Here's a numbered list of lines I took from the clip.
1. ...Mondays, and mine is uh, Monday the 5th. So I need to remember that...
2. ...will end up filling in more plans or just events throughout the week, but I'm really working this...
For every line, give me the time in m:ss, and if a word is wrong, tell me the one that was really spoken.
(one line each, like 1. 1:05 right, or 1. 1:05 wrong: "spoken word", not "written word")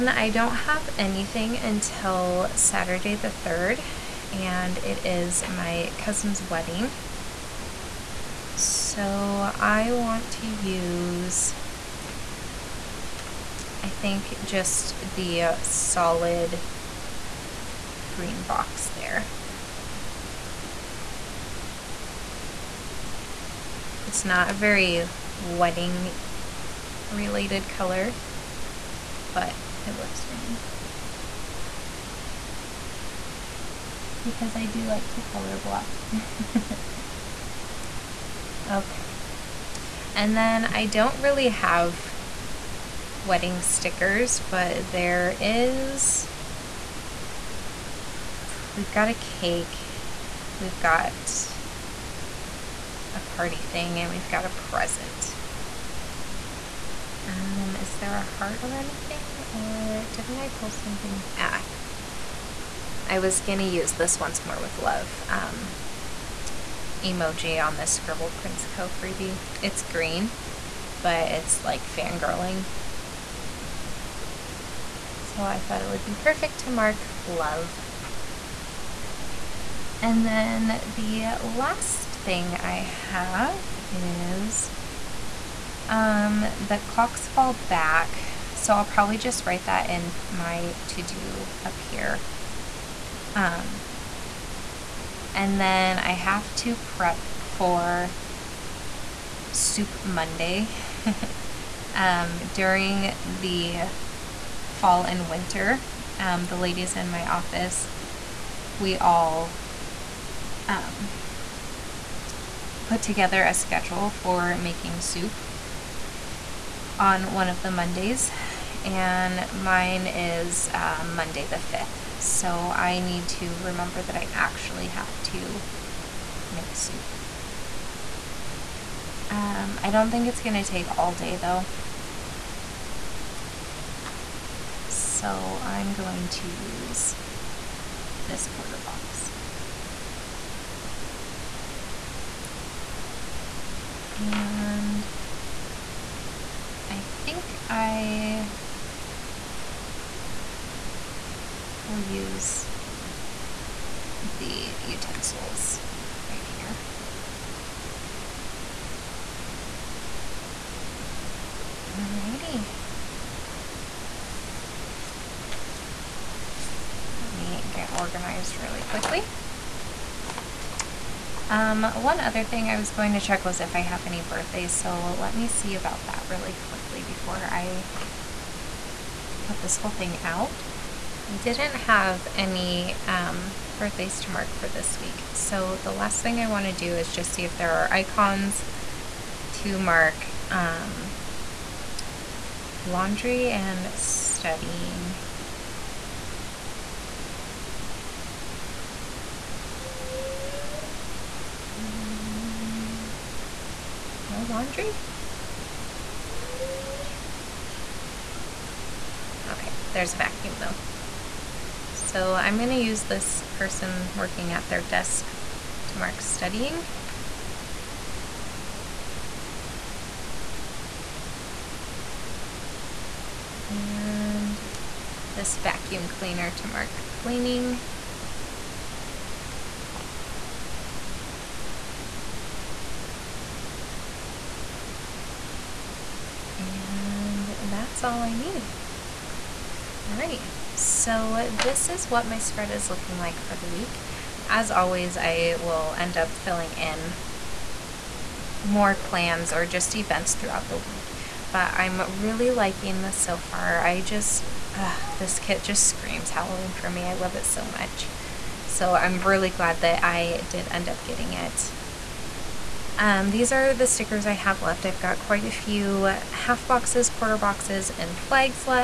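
1. 1:57 right
2. 4:05 wrong: "liking", not "working".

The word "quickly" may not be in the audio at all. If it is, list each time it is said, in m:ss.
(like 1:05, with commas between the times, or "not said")
2:48, 2:56.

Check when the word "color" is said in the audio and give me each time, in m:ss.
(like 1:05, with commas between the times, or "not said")
0:27, 0:35.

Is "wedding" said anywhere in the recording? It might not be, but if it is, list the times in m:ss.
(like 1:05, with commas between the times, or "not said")
0:06, 0:25, 0:43.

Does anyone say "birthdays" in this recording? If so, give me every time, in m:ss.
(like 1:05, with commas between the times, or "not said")
2:54, 3:03.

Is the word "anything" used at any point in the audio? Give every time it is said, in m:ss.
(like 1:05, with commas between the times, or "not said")
0:00, 0:58.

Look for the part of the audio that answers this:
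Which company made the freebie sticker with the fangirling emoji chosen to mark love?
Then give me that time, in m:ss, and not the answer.
1:07.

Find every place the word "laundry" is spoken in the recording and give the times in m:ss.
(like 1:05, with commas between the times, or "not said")
3:12, 3:24.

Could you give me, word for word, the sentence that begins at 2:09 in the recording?
Um, I don't think it's going to take all day though.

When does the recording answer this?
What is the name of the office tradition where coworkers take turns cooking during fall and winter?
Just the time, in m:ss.
1:39.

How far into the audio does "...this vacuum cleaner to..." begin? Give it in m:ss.
3:45.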